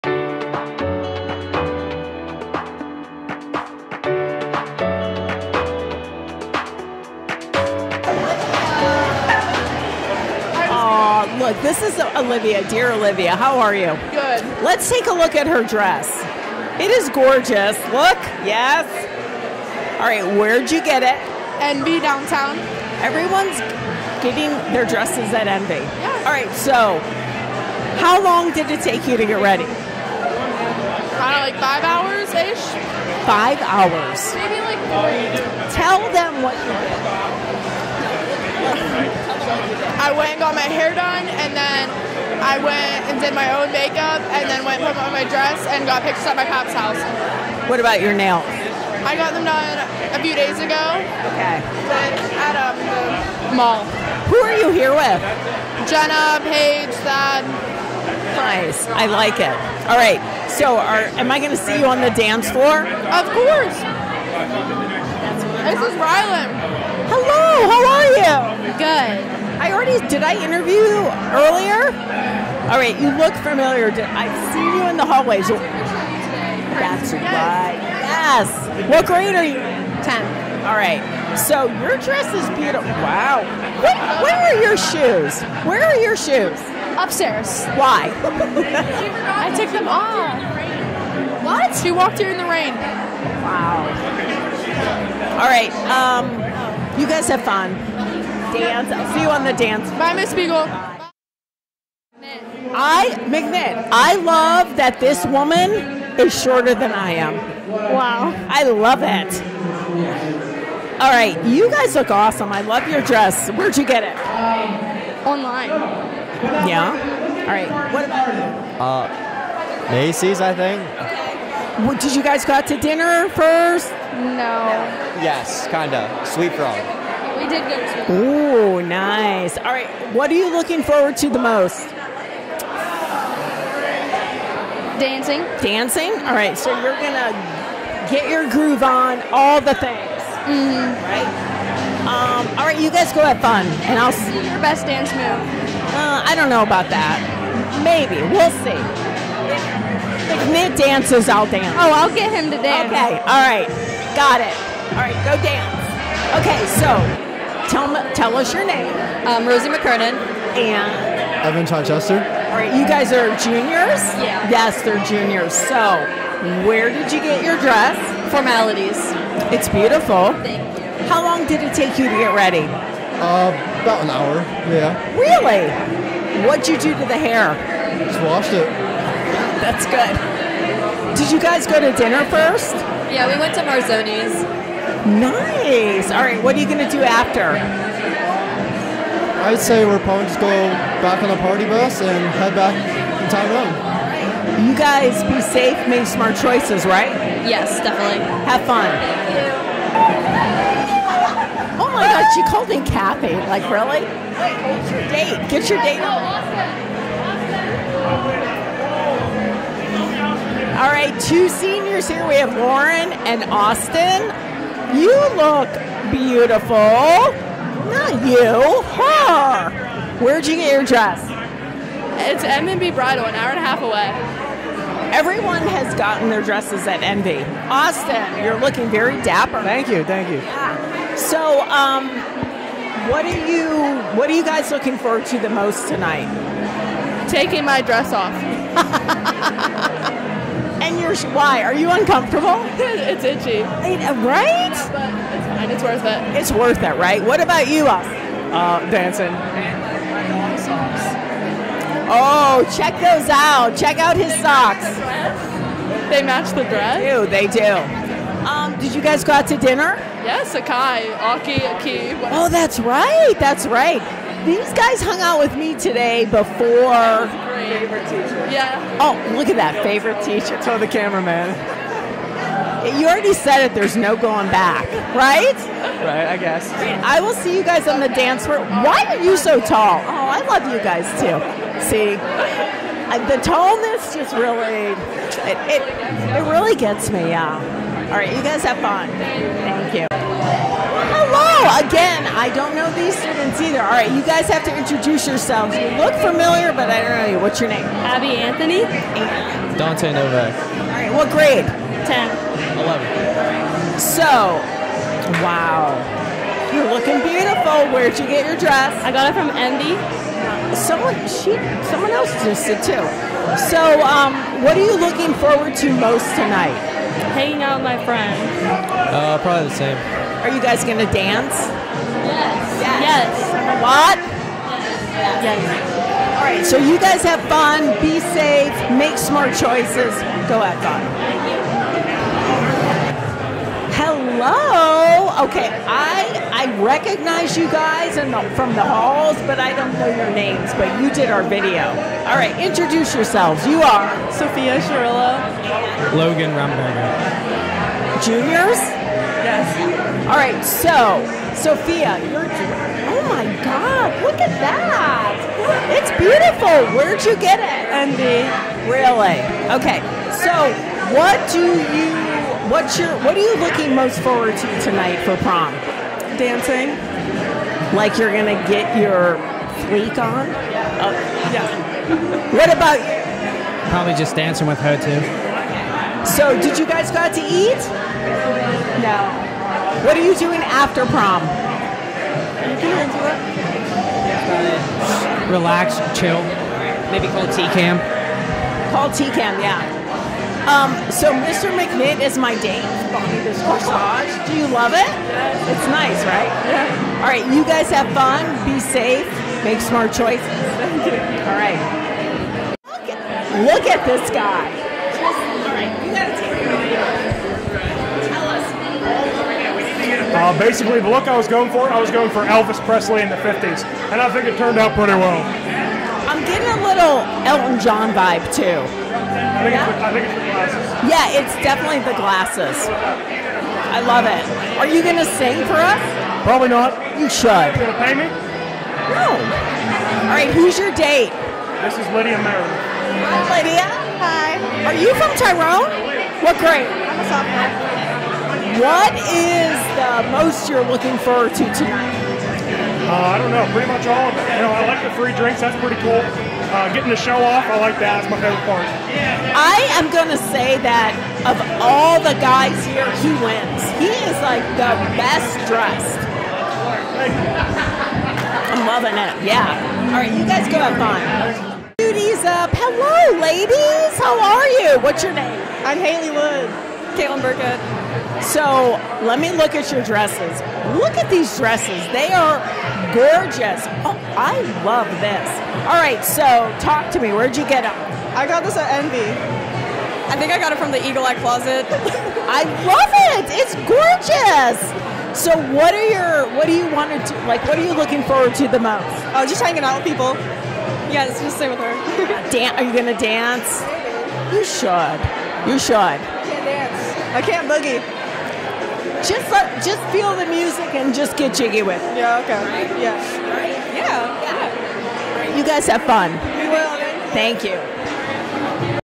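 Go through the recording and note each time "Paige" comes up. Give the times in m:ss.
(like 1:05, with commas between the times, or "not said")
0:56.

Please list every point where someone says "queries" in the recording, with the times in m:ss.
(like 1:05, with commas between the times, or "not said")
not said.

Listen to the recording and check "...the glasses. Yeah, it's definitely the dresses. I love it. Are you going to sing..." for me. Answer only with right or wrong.
wrong.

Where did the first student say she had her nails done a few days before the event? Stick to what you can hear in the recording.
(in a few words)
the mall.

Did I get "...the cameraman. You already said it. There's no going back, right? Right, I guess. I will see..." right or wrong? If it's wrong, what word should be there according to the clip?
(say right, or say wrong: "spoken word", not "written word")
right.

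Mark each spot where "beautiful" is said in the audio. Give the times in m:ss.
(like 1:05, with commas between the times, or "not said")
1:22, 2:49, 3:36, 5:07, 5:56.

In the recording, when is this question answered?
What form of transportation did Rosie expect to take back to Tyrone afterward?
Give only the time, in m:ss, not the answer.
3:11.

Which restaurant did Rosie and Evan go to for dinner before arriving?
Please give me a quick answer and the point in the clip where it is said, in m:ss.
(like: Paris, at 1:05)
Marzoni's, at 3:03.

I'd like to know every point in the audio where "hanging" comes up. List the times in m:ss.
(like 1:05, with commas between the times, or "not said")
5:17, 8:09.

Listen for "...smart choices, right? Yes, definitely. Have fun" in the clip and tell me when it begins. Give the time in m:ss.
3:16.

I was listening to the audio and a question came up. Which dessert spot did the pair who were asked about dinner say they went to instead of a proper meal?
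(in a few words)
Sweet Frog.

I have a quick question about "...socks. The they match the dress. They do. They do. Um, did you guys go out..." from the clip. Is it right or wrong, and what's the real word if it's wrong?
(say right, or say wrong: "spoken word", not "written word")
right.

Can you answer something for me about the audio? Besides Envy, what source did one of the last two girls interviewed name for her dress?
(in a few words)
Eagle Eye Closet.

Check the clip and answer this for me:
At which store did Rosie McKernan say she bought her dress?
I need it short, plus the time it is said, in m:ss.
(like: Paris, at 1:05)
Formalities, at 2:48.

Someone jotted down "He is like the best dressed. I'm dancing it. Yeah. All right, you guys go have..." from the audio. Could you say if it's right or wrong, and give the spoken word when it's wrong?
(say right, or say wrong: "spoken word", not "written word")
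wrong: "loving", not "dancing".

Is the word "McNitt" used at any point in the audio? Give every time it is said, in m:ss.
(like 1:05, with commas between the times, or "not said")
1:43, 6:31.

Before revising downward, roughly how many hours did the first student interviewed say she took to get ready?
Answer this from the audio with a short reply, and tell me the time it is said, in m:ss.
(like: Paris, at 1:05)
5, at 0:31.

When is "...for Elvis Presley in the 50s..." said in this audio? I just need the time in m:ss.
6:52.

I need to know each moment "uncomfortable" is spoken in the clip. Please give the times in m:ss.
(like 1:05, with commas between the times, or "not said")
4:01.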